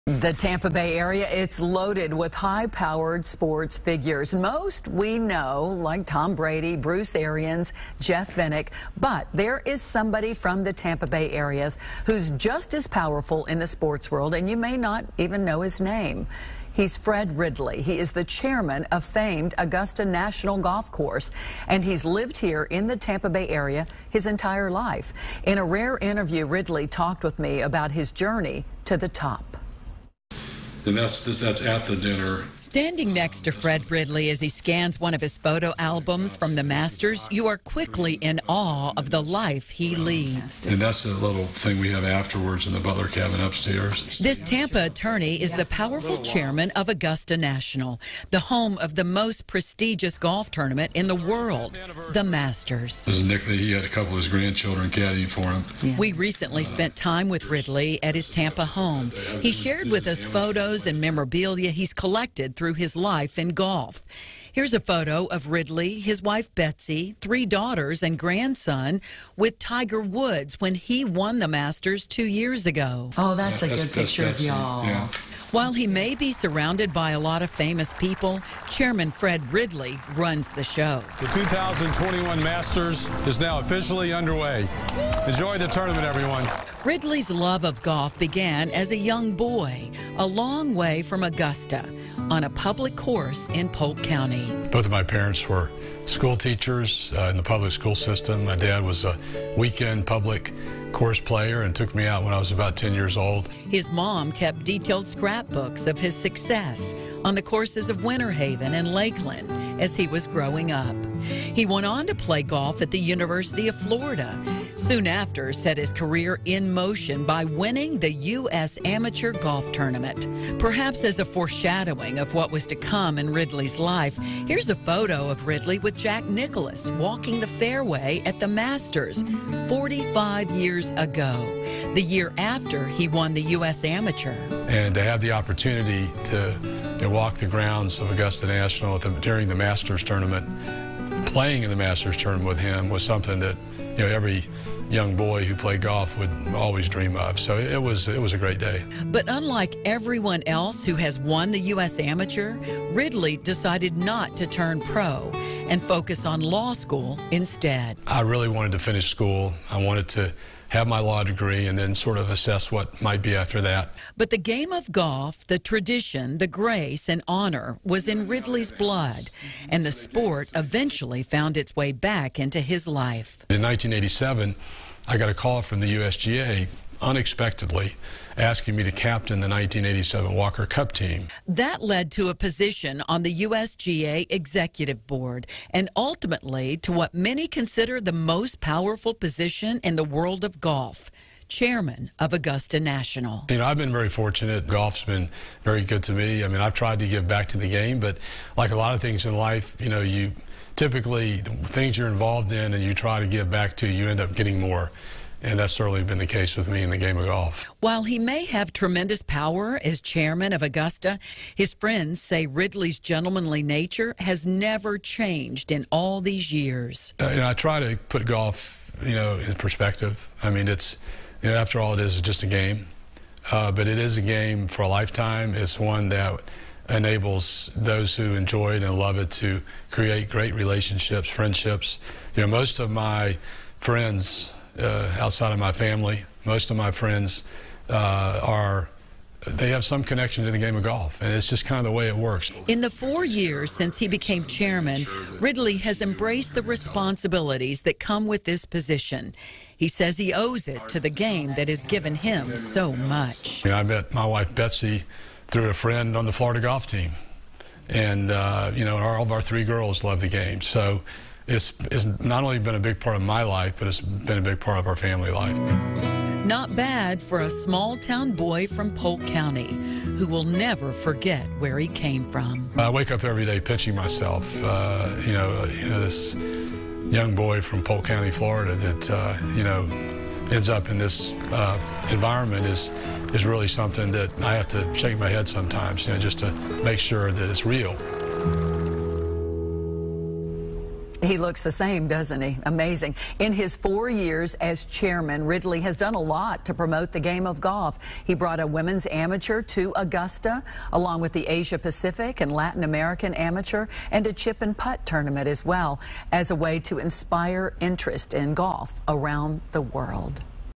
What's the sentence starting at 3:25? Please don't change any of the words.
And that's certainly been the case with me in the game of golf.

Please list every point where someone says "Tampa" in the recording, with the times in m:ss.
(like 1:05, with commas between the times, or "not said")
0:00, 0:10, 0:22, 0:44, 0:58.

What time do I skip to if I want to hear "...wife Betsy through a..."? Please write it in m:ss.
4:14.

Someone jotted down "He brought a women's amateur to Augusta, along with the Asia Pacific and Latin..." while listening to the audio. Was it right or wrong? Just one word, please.
right.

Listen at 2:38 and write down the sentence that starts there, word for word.
I really wanted to finish school.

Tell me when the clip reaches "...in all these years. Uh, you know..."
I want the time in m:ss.
3:35.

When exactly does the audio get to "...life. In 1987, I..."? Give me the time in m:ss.
2:52.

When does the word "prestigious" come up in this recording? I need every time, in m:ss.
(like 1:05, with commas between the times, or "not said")
0:49.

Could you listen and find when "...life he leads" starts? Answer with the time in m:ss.
0:39.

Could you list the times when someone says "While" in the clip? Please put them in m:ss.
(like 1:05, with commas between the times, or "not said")
1:15, 3:27.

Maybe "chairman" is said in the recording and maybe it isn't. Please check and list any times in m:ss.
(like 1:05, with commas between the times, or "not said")
0:18, 0:46, 1:18, 3:11, 3:29, 4:04, 4:54.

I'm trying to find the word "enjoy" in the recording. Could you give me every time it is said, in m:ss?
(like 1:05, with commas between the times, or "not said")
1:25, 3:48.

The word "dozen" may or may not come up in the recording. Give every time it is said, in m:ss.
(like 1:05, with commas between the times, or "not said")
not said.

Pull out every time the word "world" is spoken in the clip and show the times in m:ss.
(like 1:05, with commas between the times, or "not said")
0:14, 0:51, 3:10, 5:09.